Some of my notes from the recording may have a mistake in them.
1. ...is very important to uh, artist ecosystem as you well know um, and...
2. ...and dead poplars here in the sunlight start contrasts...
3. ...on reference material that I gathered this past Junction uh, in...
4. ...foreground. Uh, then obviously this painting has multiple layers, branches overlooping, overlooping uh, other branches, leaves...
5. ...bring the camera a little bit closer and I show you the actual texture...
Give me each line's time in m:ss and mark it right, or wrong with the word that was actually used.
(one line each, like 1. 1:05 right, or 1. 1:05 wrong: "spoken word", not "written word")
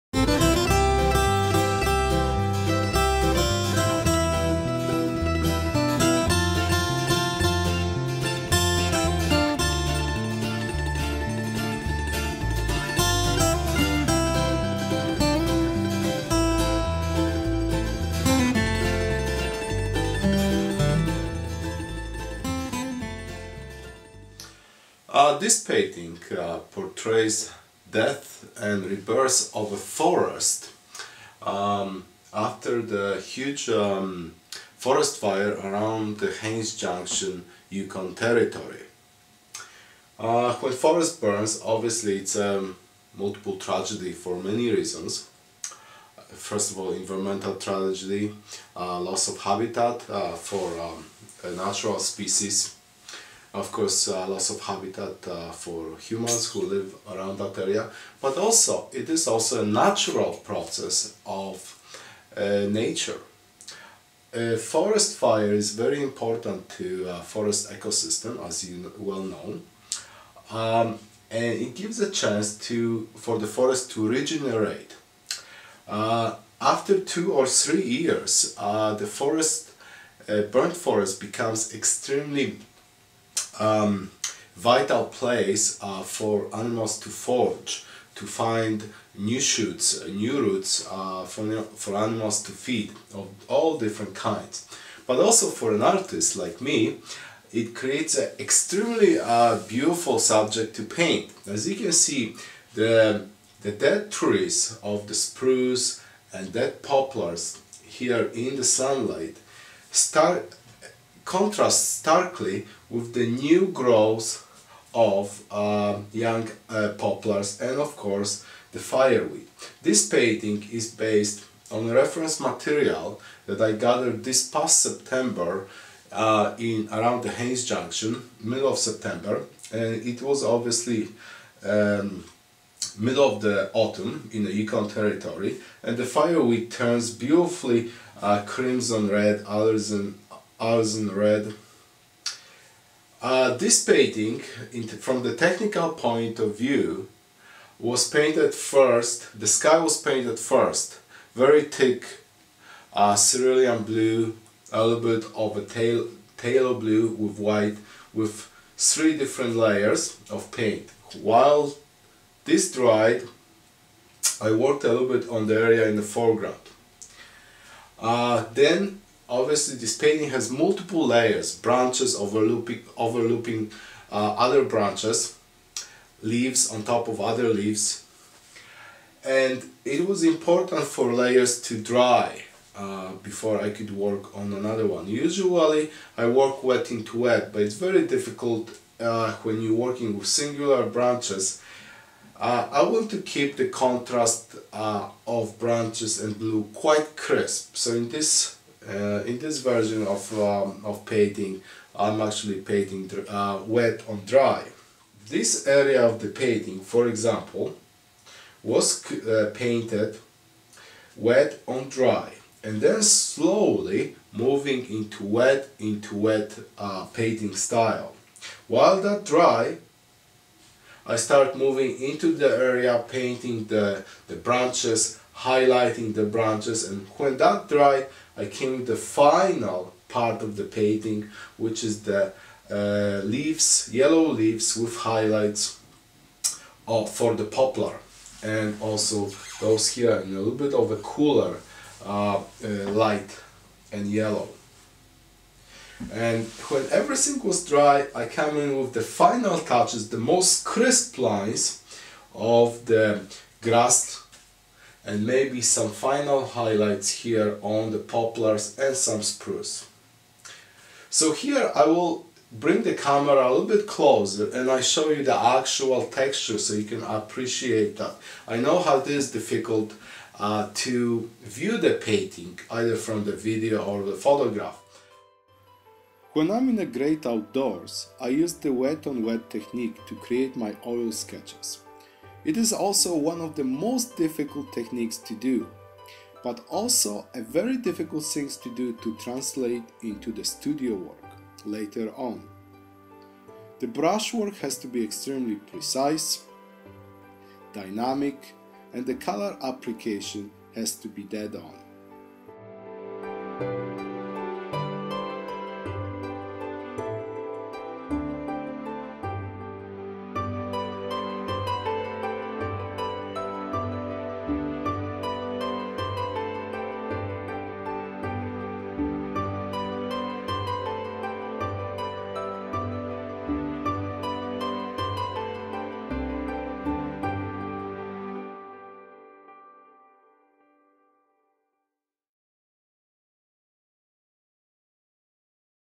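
1. 1:05 wrong: "forest", not "artist"
2. 1:46 right
3. 2:01 wrong: "September", not "Junction"
4. 2:46 right
5. 4:22 right.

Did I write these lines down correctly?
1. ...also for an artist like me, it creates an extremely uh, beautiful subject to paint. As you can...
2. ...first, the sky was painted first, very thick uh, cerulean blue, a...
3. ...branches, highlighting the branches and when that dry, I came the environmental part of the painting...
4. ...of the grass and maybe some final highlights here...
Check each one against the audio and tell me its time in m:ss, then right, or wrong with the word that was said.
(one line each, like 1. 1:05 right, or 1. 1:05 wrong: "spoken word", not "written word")
1. 1:35 right
2. 2:28 right
3. 3:44 wrong: "final", not "environmental"
4. 4:12 right.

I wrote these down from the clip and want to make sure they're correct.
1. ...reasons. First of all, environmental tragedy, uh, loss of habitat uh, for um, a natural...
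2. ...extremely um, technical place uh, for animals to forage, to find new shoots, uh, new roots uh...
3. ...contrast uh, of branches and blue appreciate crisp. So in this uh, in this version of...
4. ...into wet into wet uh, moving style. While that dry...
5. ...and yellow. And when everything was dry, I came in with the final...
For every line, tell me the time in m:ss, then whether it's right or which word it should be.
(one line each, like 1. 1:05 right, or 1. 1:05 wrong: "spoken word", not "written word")
1. 0:44 right
2. 1:21 wrong: "vital", not "technical"
3. 3:13 wrong: "quite", not "appreciate"
4. 3:34 wrong: "painting", not "moving"
5. 4:03 right.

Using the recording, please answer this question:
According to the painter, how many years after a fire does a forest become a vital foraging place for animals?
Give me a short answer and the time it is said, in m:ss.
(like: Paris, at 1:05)
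2 or 3, at 1:16.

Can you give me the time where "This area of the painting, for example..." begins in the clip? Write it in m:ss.
3:25.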